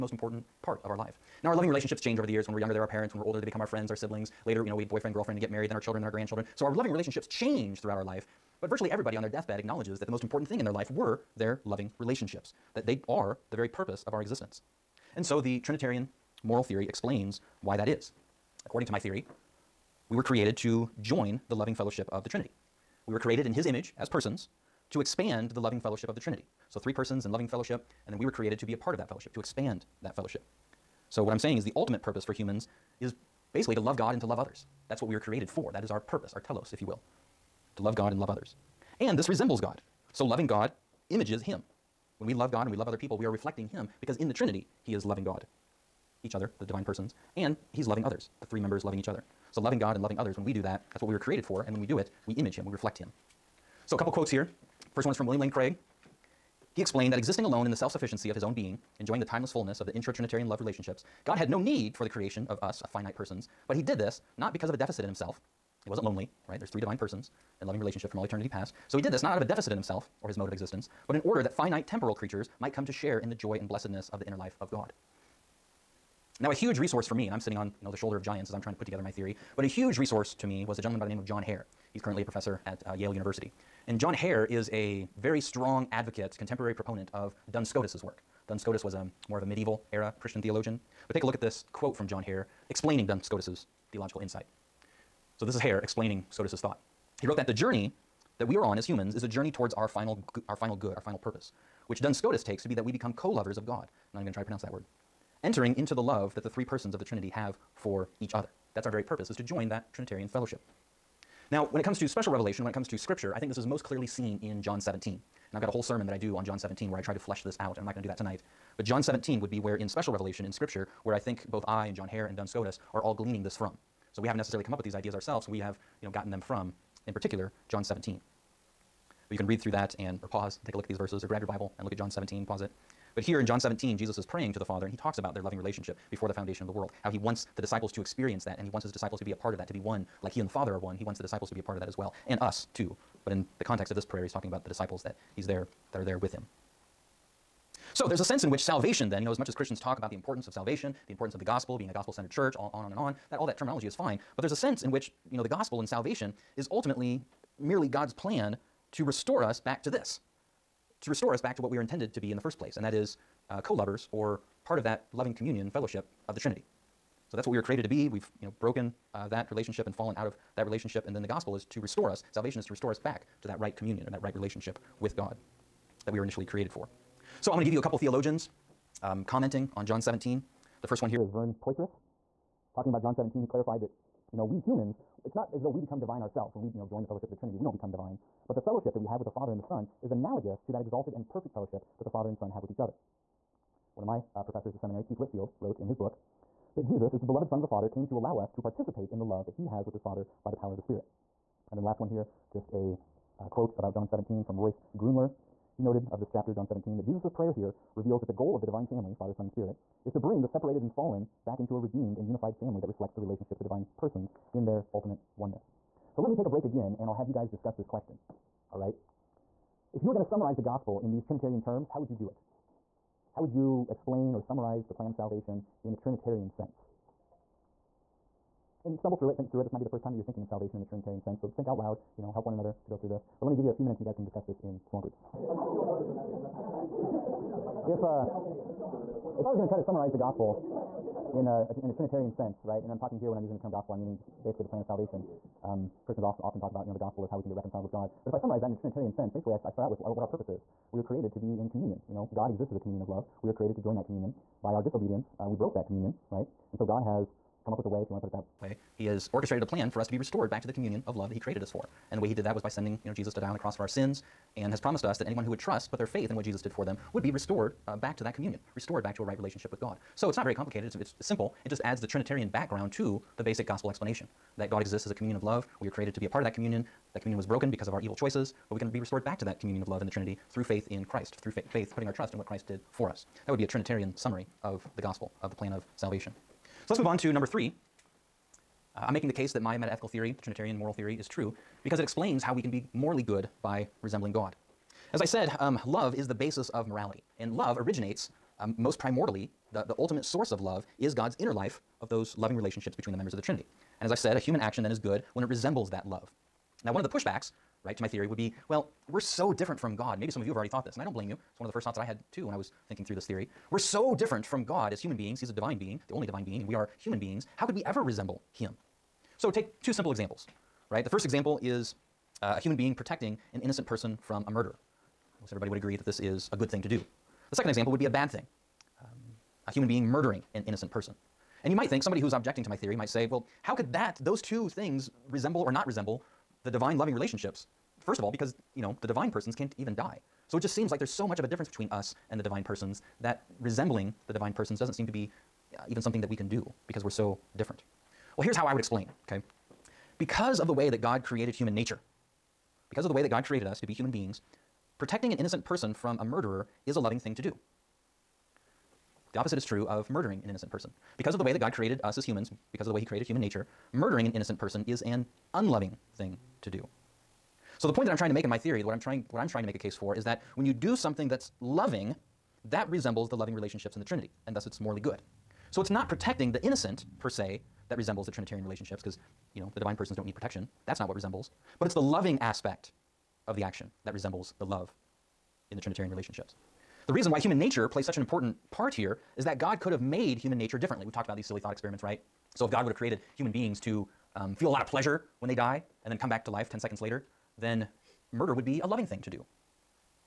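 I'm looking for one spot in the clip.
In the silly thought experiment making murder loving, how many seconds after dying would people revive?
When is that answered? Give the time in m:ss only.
6:36.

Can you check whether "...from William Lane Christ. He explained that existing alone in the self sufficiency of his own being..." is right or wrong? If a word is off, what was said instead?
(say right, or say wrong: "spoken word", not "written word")
wrong: "Craig", not "Christ".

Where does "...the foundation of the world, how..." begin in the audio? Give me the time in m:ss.
2:16.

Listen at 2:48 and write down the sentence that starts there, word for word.
We've you know, broken uh, that relationship and fallen out of that relationship.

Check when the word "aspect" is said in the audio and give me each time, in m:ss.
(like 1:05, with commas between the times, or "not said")
6:22.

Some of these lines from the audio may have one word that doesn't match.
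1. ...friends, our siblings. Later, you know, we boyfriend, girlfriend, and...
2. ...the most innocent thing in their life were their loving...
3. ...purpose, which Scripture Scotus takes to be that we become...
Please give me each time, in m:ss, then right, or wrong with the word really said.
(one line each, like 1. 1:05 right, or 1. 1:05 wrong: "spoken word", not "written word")
1. 0:03 right
2. 0:10 wrong: "important", not "innocent"
3. 1:41 wrong: "Duns", not "Scripture".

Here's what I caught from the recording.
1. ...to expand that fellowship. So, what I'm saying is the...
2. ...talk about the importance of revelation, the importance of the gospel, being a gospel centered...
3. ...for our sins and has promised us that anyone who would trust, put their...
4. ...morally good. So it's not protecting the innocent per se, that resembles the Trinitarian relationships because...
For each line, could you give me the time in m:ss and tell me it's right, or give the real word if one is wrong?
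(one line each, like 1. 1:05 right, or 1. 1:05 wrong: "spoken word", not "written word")
1. 0:29 right
2. 2:29 wrong: "salvation", not "revelation"
3. 4:23 right
4. 6:14 right.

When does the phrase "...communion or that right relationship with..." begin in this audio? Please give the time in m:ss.
2:53.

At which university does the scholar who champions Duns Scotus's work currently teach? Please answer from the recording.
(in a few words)
Yale University.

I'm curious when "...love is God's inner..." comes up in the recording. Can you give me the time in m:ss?
5:00.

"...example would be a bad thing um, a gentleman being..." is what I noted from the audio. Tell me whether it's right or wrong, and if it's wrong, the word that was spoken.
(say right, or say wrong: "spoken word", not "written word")
wrong: "human", not "gentleman".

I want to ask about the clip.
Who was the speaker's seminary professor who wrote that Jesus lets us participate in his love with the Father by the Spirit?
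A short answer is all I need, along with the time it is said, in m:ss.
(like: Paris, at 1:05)
Keith Whitfield, at 3:15.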